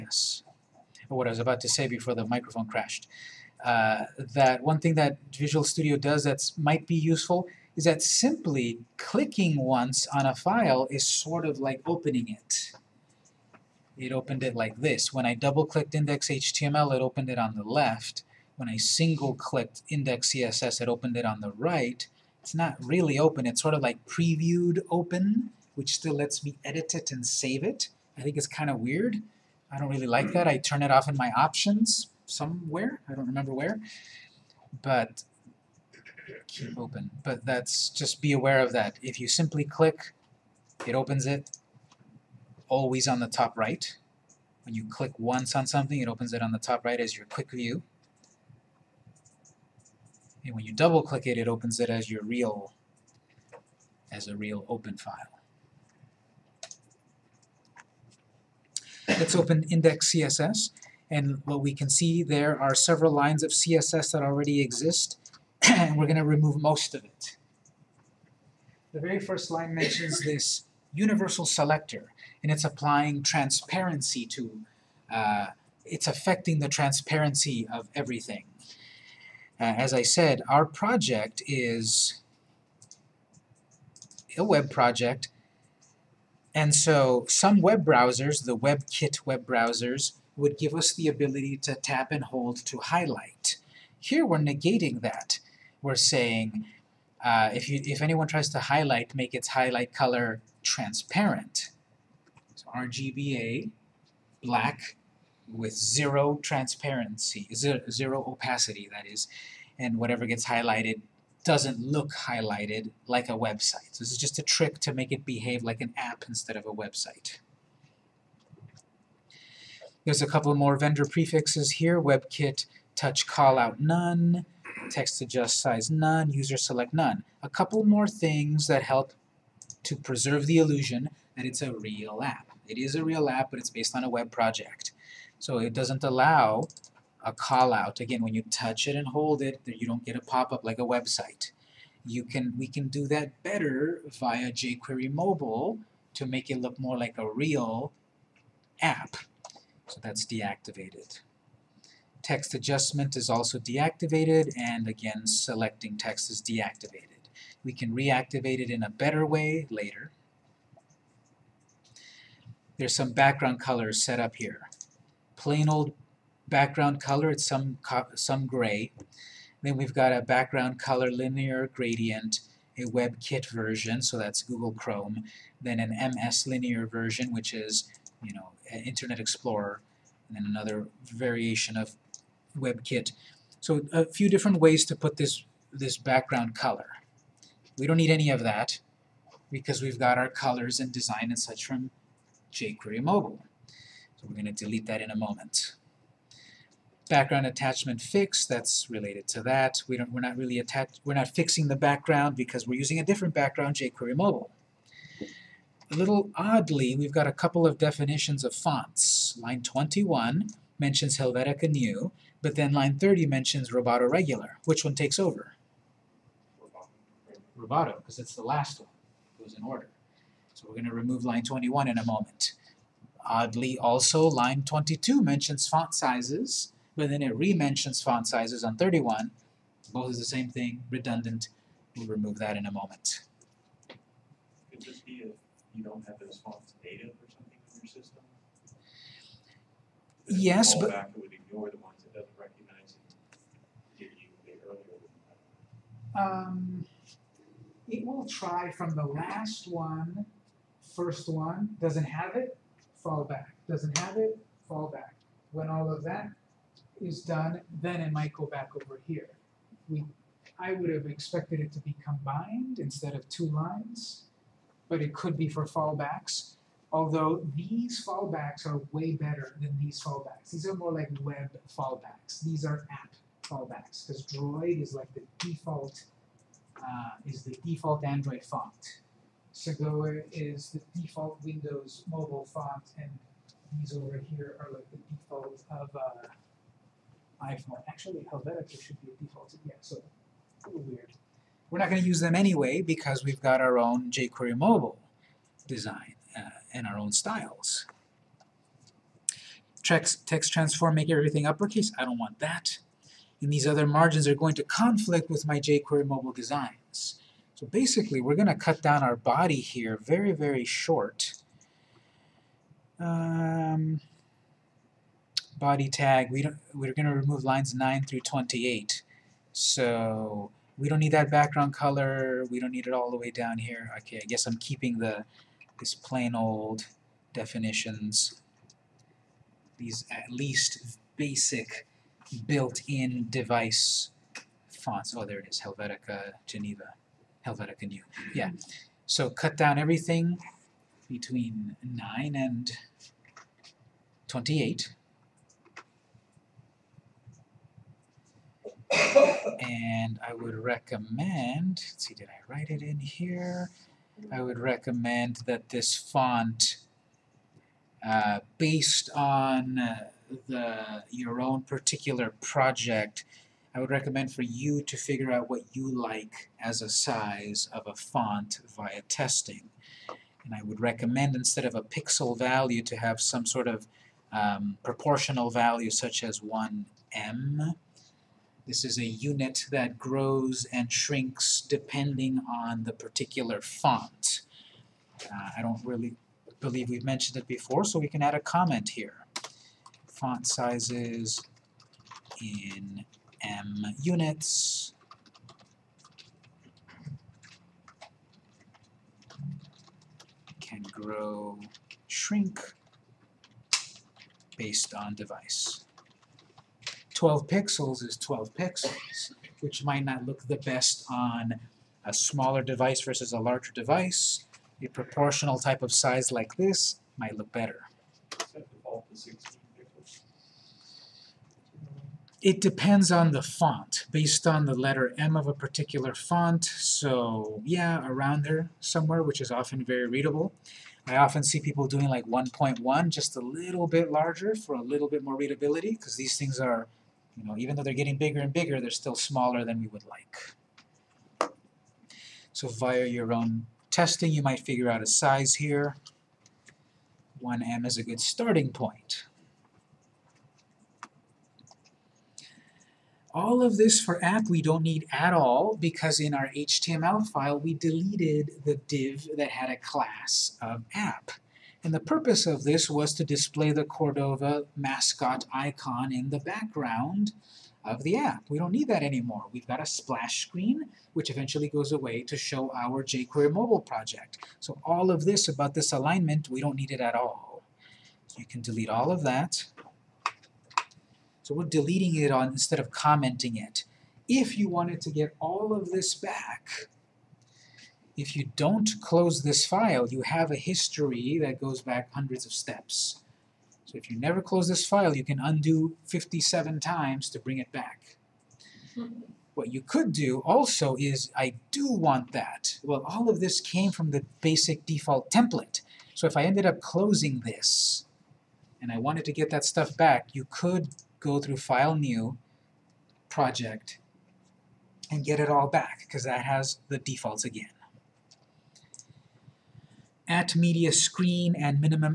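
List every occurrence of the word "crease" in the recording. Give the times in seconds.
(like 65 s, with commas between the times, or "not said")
not said.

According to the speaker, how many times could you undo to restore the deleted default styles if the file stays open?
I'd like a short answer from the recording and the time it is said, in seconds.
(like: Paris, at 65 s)
57, at 496 s.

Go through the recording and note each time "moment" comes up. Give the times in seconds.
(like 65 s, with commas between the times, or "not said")
195 s, 222 s, 232 s.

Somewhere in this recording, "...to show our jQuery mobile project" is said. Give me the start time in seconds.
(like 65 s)
472 s.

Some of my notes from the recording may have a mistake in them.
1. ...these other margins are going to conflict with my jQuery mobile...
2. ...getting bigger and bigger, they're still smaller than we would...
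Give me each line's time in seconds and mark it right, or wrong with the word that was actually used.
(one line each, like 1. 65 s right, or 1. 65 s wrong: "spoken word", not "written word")
1. 303 s right
2. 437 s right.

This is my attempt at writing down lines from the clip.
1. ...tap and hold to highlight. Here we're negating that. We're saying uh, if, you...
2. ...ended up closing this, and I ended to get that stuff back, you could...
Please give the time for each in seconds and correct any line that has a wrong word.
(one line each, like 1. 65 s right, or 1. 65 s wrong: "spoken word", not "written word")
1. 91 s right
2. 506 s wrong: "wanted", not "ended".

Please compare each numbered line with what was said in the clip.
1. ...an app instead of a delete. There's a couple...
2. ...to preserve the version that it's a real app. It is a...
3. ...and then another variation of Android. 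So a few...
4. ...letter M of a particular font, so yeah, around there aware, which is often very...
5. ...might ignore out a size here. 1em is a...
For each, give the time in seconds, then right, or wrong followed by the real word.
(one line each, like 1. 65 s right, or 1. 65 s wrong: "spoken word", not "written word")
1. 115 s wrong: "website", not "delete"
2. 129 s wrong: "illusion", not "version"
3. 180 s wrong: "WebKit", not "Android"
4. 424 s wrong: "somewhere", not "aware"
5. 444 s wrong: "figure", not "ignore".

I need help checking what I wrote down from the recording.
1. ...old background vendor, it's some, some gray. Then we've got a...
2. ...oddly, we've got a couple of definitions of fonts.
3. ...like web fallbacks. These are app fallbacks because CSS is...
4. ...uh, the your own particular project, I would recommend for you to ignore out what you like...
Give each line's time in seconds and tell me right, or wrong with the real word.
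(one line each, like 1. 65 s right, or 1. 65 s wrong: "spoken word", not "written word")
1. 165 s wrong: "color", not "vendor"
2. 206 s right
3. 270 s wrong: "Droid", not "CSS"
4. 359 s wrong: "figure", not "ignore".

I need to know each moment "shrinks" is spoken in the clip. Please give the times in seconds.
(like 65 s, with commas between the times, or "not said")
380 s, 402 s.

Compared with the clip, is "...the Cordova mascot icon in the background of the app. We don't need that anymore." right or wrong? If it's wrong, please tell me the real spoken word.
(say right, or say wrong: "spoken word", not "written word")
right.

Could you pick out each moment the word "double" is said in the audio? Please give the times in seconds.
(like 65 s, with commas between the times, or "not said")
15 s, 50 s.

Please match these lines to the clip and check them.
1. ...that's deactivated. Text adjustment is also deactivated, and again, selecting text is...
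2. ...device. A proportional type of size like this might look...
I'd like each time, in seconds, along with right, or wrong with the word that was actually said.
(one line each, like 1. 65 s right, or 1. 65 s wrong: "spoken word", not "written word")
1. 150 s right
2. 413 s right.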